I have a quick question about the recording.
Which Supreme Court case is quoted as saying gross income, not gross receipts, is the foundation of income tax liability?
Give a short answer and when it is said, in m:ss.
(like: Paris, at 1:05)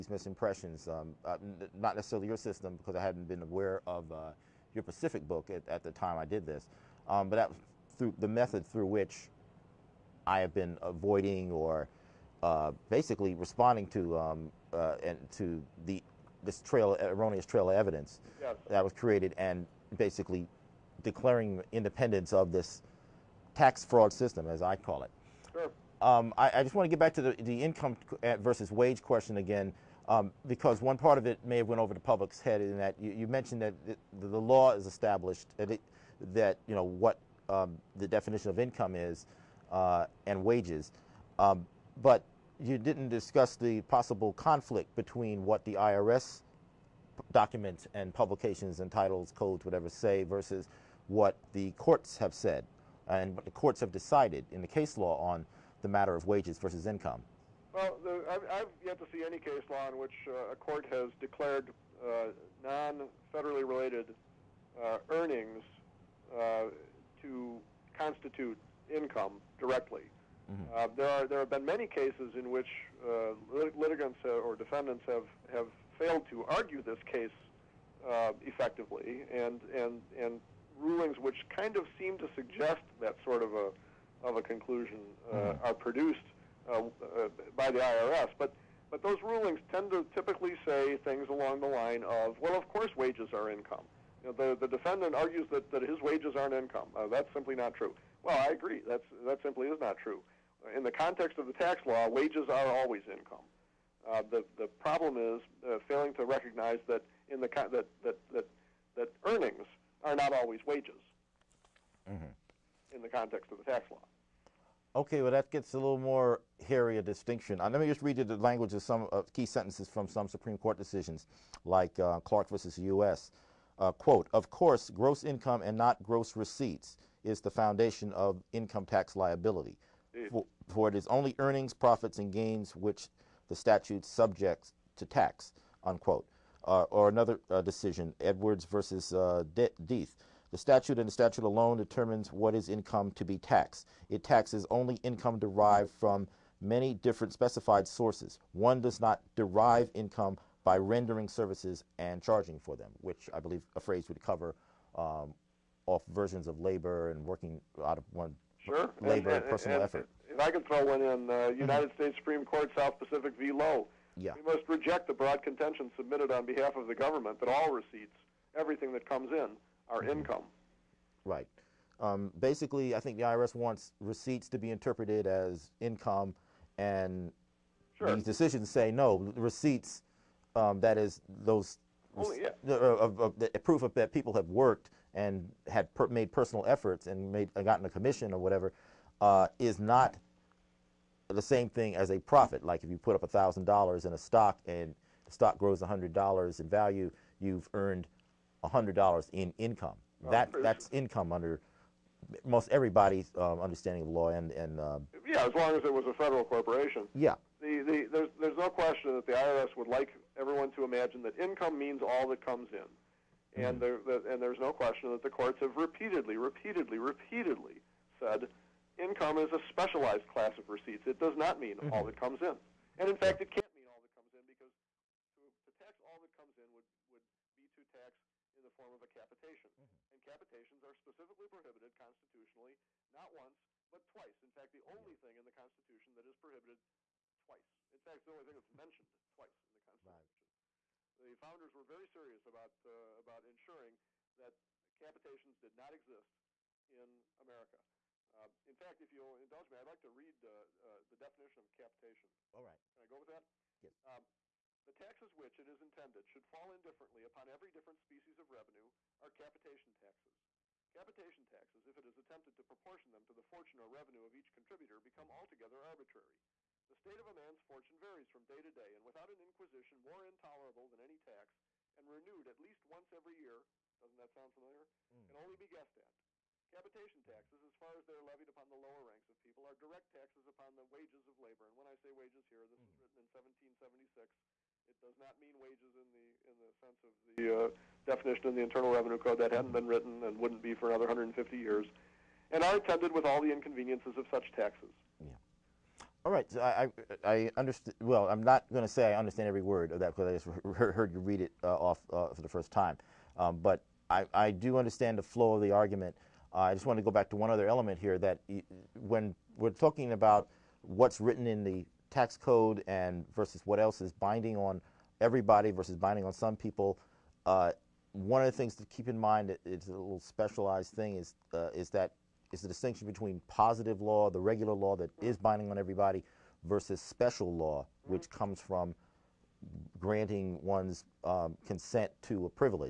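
Clark versus U.S., at 2:02.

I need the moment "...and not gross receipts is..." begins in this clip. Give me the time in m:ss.
2:05.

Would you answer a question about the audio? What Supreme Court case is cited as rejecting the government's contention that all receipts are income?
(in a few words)
Southern Pacific v. Lowe.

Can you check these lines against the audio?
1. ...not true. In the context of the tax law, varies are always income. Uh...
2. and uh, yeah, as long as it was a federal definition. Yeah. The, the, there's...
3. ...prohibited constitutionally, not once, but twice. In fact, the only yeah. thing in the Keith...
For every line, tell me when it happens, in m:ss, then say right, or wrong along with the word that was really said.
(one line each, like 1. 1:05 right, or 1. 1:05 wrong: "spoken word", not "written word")
1. 1:39 wrong: "wages", not "varies"
2. 3:24 wrong: "corporation", not "definition"
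3. 3:51 wrong: "Constitution", not "Keith".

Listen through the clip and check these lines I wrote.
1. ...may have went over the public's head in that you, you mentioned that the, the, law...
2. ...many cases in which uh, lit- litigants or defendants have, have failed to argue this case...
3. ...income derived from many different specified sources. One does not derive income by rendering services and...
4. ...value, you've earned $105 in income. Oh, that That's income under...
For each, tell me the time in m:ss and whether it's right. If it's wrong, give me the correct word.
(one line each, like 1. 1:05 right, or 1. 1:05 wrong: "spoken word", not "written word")
1. 0:31 right
2. 1:11 right
3. 2:25 right
4. 3:16 wrong: "100", not "105".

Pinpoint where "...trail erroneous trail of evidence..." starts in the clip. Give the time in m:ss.
0:16.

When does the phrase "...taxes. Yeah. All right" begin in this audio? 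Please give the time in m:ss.
4:54.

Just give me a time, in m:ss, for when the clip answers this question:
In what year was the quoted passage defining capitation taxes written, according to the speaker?
4:43.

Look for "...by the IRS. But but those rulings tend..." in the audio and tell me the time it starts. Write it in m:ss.
1:27.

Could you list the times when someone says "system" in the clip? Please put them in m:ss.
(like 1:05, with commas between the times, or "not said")
0:02, 0:24.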